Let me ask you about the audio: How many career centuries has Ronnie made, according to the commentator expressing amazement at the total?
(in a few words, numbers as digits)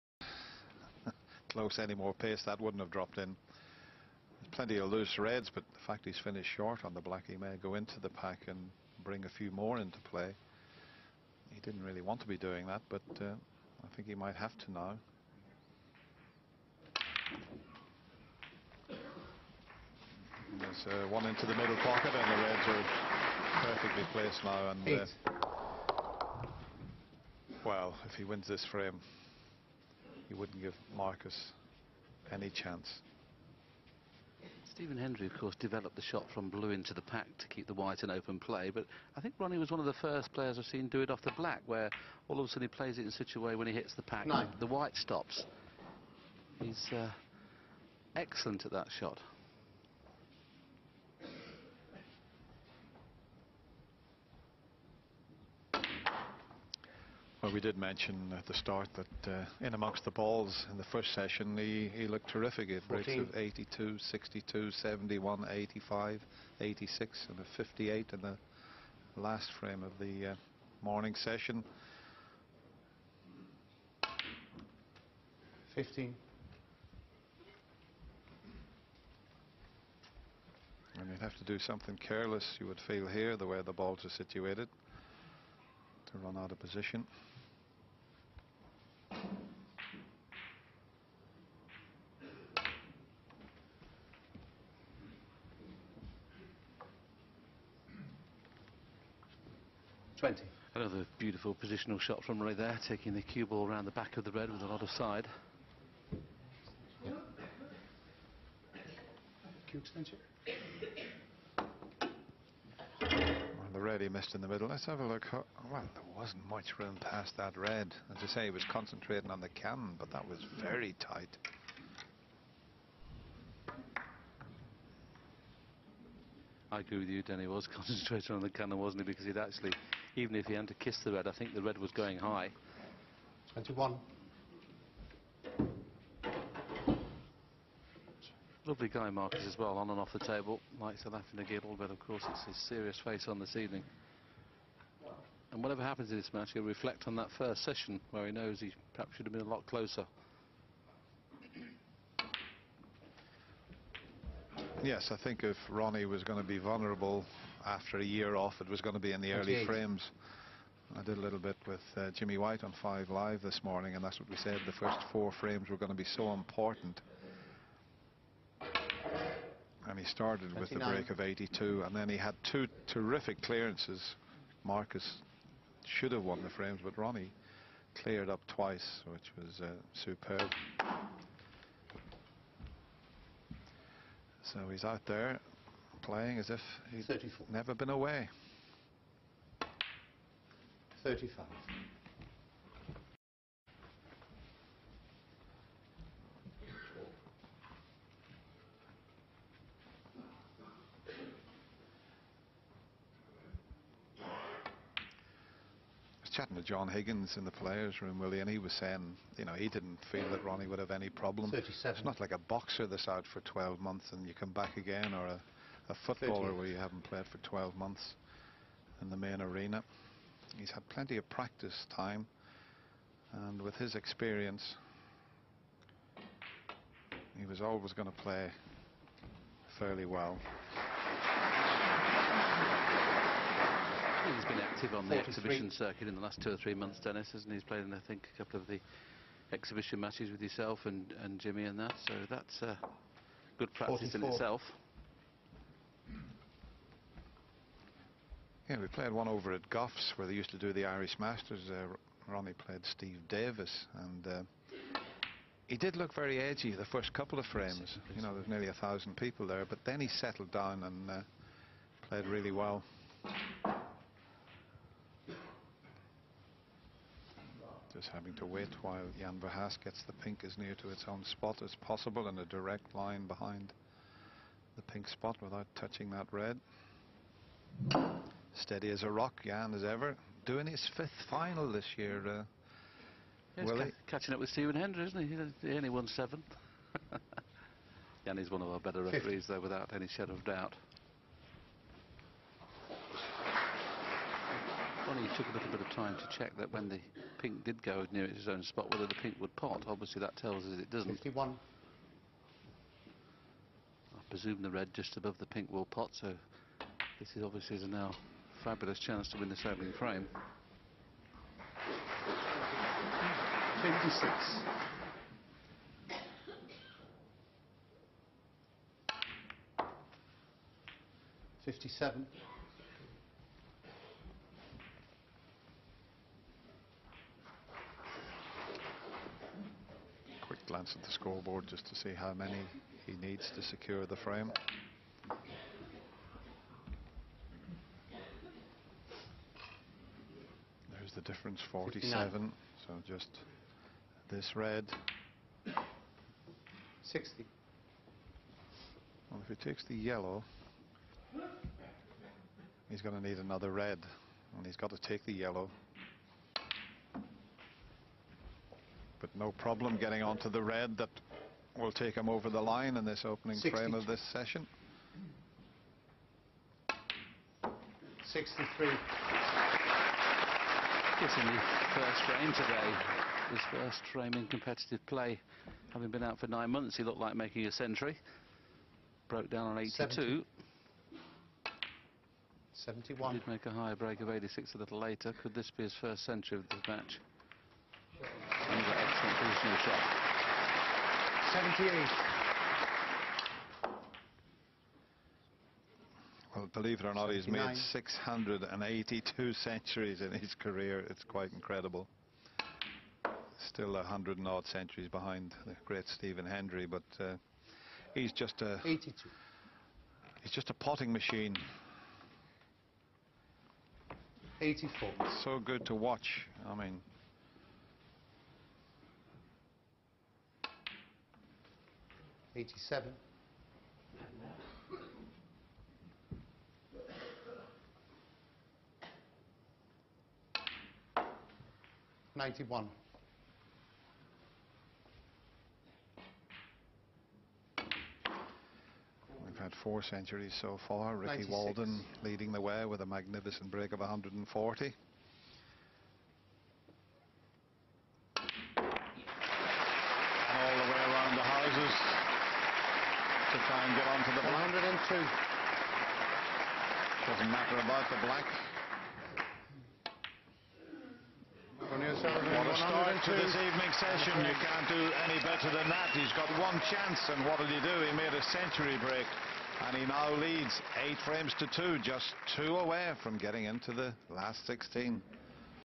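682.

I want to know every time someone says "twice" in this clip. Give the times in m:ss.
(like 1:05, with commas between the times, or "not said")
2:58.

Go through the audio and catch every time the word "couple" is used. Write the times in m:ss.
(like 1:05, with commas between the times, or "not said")
3:58, 4:17.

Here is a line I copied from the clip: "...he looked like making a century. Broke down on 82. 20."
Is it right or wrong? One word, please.
wrong.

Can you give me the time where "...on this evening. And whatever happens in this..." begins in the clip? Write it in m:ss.
2:23.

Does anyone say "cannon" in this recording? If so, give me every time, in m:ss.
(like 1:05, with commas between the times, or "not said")
1:59, 2:08.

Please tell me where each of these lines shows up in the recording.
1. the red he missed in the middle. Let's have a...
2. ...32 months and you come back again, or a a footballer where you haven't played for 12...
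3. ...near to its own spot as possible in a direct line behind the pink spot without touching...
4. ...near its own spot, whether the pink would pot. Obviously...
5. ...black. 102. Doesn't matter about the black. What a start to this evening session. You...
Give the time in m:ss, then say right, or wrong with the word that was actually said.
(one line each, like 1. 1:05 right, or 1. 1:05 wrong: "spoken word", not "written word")
1. 1:53 right
2. 3:33 wrong: "12", not "32"
3. 4:30 right
4. 4:58 right
5. 7:34 right.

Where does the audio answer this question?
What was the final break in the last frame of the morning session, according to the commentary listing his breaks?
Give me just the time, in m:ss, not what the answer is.
1:07.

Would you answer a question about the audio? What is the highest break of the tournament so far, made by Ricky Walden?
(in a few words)
140.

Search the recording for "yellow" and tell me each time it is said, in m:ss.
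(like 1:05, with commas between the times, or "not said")
5:49, 5:55.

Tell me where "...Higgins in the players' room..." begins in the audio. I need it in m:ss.
3:26.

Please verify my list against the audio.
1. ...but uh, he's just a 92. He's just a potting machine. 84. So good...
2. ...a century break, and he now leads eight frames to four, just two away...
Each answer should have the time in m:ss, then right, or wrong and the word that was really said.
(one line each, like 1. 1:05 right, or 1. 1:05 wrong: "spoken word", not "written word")
1. 6:46 wrong: "82", not "92"
2. 7:48 wrong: "two", not "four".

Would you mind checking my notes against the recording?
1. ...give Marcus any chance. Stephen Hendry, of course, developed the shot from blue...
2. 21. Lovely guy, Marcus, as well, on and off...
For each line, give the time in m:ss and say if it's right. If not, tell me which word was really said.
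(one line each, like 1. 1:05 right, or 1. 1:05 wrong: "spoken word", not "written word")
1. 0:30 right
2. 2:13 right.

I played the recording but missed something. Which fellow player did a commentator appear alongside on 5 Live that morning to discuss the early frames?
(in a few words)
Jimmy White.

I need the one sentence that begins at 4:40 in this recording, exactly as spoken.
Doing his fifth final this year, uh, yeah, ca catching up with Stephen Hendry, isn't he?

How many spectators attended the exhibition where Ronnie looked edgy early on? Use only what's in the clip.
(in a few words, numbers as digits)
1,000.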